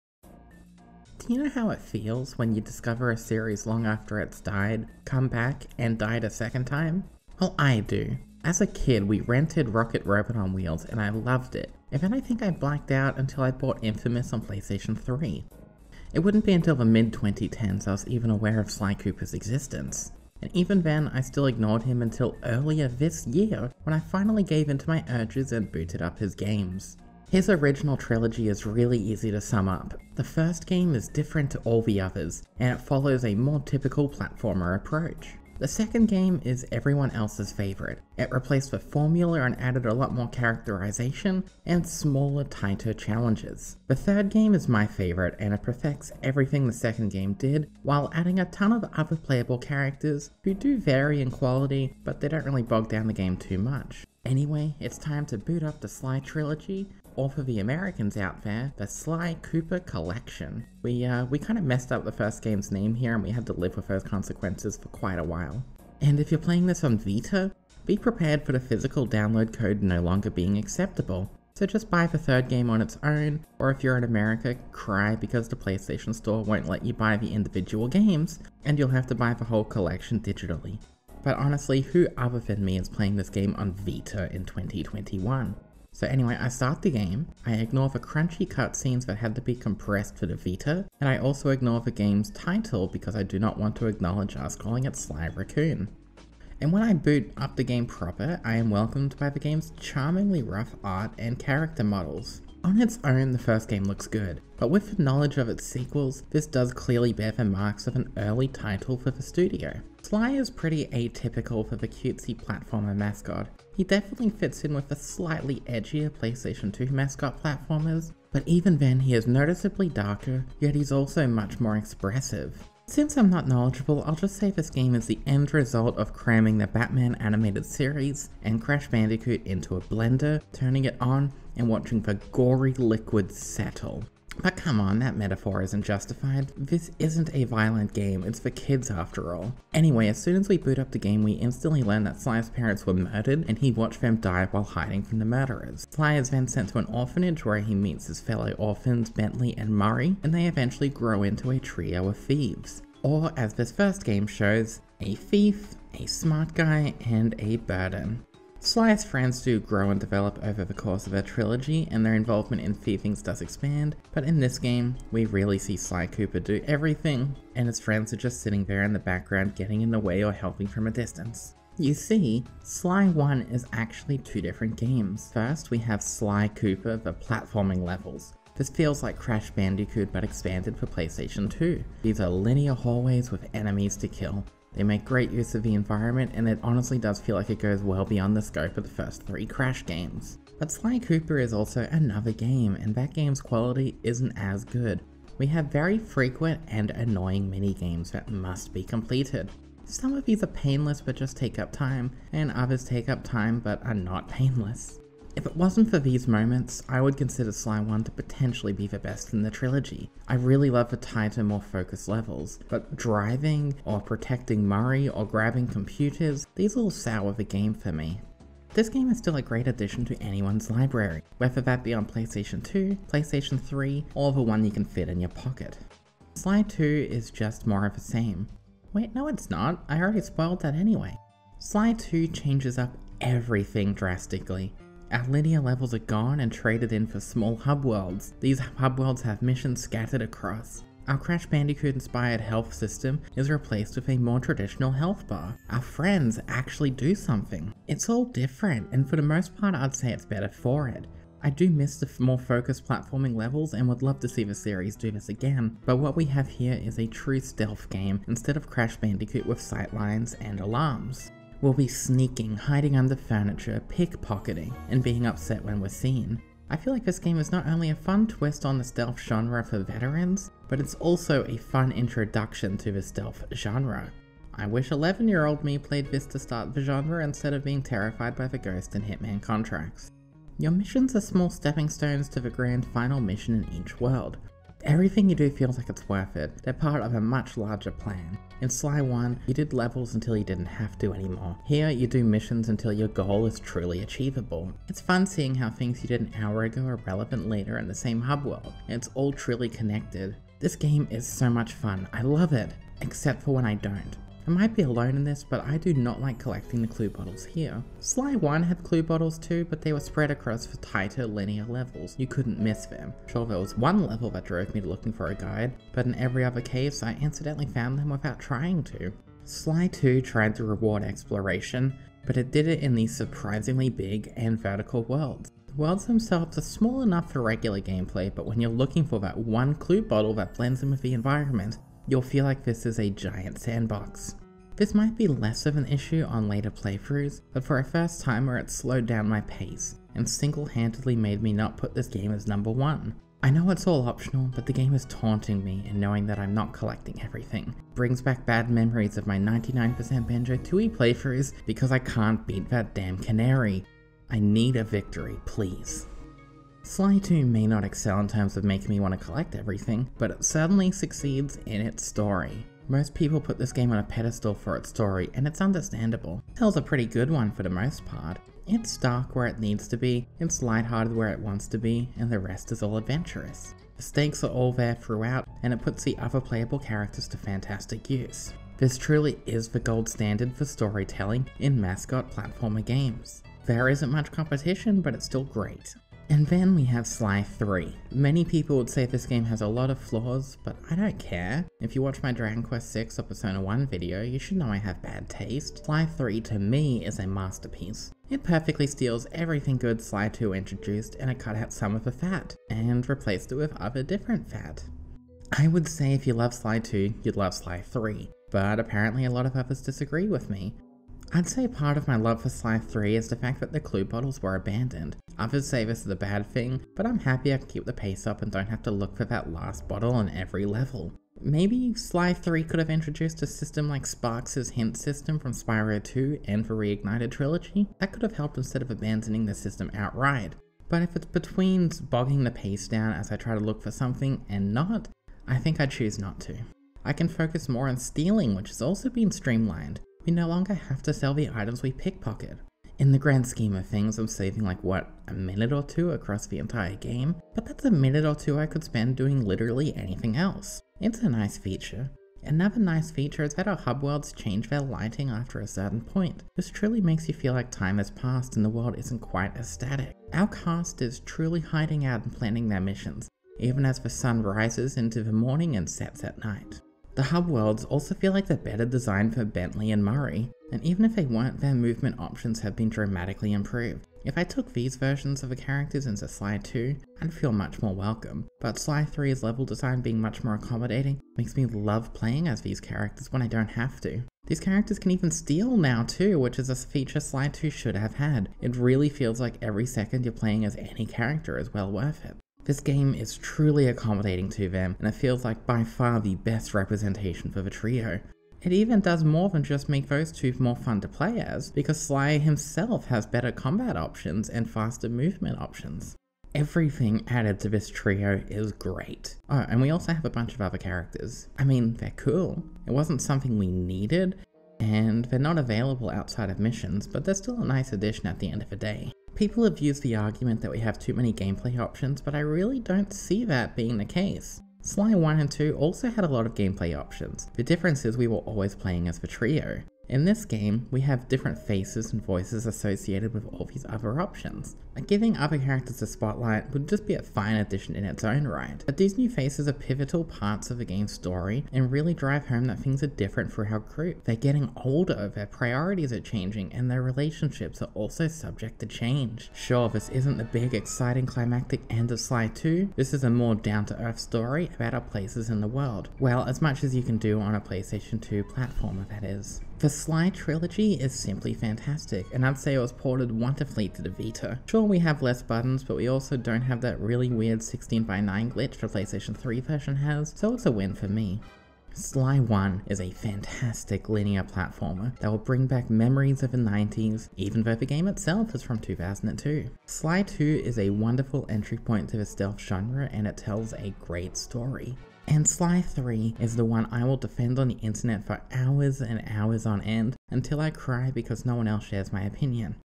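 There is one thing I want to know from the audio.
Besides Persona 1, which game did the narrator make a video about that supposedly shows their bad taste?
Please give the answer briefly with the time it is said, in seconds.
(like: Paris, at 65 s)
Dragon Quest 6, at 392 s.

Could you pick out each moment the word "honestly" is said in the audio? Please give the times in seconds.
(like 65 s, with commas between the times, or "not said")
81 s, 186 s.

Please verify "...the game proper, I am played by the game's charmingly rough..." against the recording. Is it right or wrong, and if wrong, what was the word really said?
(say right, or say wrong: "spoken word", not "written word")
wrong: "welcomed", not "played".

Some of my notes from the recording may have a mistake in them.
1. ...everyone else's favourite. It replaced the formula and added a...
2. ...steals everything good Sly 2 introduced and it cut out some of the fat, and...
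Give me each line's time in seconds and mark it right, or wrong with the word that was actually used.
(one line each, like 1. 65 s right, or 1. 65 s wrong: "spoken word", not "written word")
1. 36 s right
2. 398 s right.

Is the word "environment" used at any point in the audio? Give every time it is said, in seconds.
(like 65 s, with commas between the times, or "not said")
185 s, 331 s.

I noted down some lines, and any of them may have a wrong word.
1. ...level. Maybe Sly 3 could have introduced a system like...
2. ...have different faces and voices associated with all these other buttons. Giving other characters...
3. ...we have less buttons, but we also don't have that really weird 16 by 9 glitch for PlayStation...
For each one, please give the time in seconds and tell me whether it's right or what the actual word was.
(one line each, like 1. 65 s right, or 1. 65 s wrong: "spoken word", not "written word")
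1. 420 s right
2. 531 s wrong: "options", not "buttons"
3. 564 s right.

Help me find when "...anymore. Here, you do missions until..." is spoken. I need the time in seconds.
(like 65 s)
291 s.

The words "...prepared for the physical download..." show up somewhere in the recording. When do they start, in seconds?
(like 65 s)
67 s.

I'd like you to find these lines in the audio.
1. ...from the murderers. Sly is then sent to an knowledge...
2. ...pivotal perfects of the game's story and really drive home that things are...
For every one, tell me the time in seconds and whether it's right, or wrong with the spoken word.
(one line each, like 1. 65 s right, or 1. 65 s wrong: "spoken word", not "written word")
1. 145 s wrong: "orphanage", not "knowledge"
2. 539 s wrong: "parts", not "perfects".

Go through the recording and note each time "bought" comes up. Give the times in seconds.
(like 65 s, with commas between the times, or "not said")
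13 s.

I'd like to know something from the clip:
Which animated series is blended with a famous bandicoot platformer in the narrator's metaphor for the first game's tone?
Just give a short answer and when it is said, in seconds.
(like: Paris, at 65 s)
the Batman animated series, at 126 s.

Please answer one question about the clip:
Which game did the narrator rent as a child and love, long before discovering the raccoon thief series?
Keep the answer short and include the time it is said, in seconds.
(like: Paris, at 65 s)
Rocket Robot on Wheels, at 9 s.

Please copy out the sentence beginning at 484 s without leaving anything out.
These characters can even steal now too, which is a feature Sly 2 should have had.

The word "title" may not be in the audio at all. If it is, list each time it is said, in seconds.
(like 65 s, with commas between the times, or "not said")
92 s, 108 s.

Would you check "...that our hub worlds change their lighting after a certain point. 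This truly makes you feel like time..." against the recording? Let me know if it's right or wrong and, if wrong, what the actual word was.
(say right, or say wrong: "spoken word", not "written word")
right.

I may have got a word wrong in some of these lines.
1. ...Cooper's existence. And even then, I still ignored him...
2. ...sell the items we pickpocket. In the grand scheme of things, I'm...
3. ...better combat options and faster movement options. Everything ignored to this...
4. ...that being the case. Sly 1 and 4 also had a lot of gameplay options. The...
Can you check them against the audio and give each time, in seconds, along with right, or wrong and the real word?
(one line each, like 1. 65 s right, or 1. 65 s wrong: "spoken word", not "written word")
1. 18 s right
2. 441 s right
3. 503 s wrong: "added", not "ignored"
4. 523 s wrong: "2", not "4".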